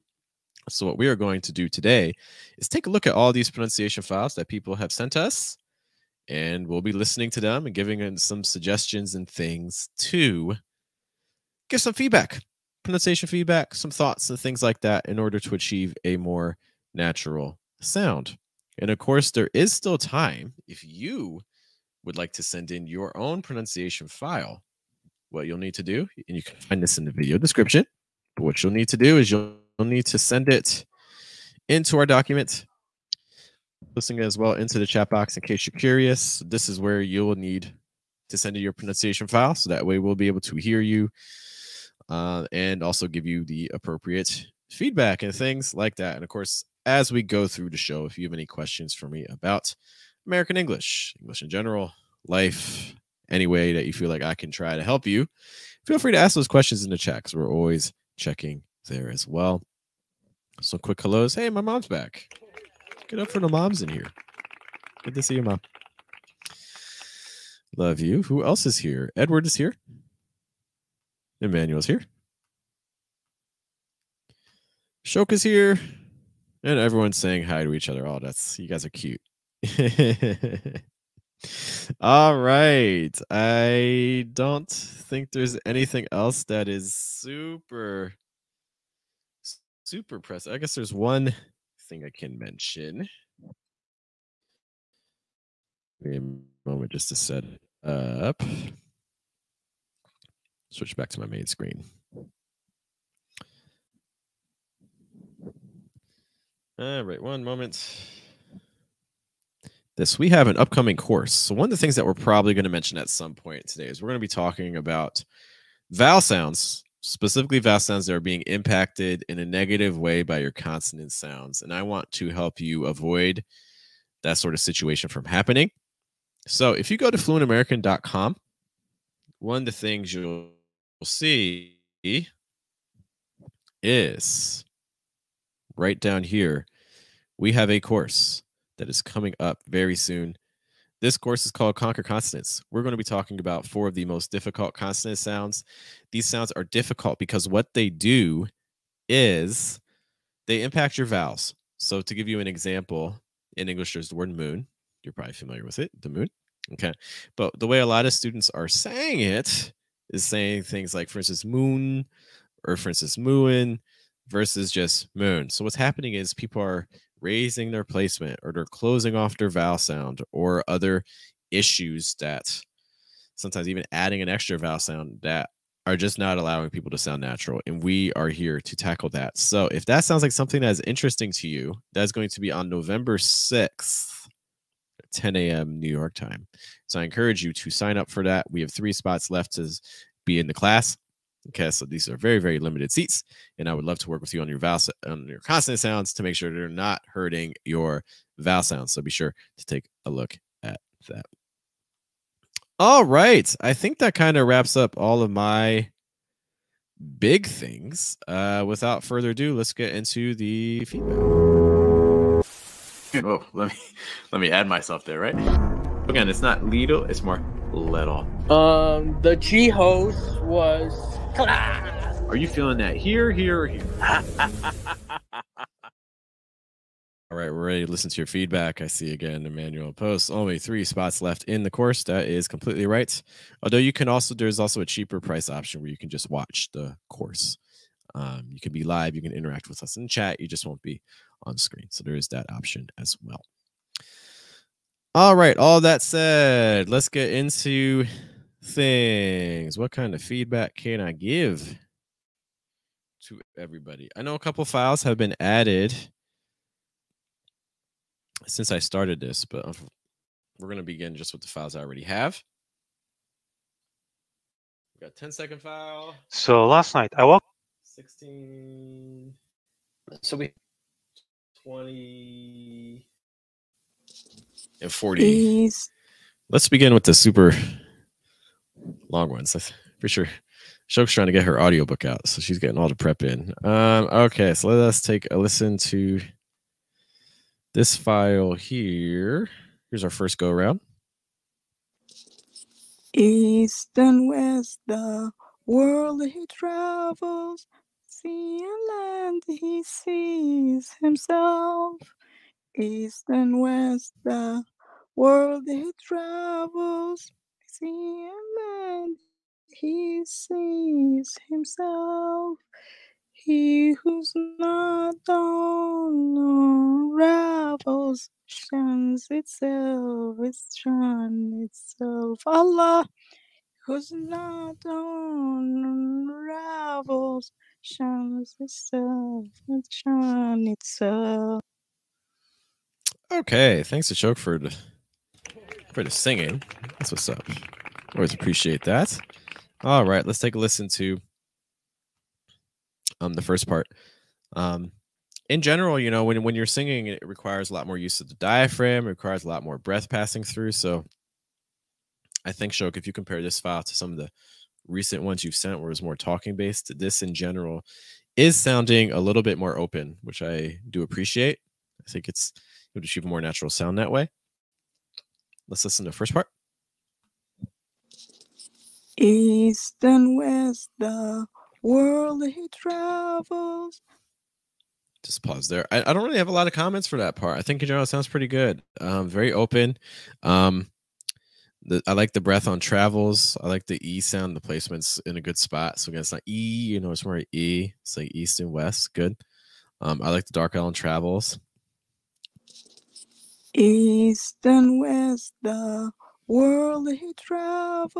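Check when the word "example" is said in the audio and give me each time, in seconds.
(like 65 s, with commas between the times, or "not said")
152 s.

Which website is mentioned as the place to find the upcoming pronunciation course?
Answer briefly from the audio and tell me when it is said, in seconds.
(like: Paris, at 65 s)
fluentamerican.com, at 127 s.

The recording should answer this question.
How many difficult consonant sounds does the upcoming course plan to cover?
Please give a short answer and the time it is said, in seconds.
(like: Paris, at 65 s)
4, at 143 s.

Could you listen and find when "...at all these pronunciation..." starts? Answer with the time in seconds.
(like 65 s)
3 s.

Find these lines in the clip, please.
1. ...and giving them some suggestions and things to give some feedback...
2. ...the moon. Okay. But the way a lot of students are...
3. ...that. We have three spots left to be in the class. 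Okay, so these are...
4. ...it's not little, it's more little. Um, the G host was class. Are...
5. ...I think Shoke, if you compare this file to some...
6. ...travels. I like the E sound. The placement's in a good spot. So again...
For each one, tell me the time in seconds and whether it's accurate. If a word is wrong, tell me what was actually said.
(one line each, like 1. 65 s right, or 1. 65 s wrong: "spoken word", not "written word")
1. 7 s right
2. 156 s right
3. 188 s right
4. 216 s right
5. 352 s right
6. 382 s right.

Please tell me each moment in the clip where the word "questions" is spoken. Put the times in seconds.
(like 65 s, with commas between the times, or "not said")
48 s, 56 s.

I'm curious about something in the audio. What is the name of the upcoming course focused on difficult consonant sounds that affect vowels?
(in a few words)
Conquer Consonants.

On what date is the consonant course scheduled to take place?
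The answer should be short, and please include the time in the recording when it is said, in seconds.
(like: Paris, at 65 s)
November 6th, at 182 s.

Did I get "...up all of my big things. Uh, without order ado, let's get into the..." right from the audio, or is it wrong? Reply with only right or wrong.
wrong.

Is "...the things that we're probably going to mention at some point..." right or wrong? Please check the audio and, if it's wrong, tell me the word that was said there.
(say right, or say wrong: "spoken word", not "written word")
right.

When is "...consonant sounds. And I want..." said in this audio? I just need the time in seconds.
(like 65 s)
120 s.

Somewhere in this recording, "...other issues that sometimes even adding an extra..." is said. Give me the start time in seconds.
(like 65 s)
170 s.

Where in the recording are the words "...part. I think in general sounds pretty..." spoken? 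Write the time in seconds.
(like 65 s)
377 s.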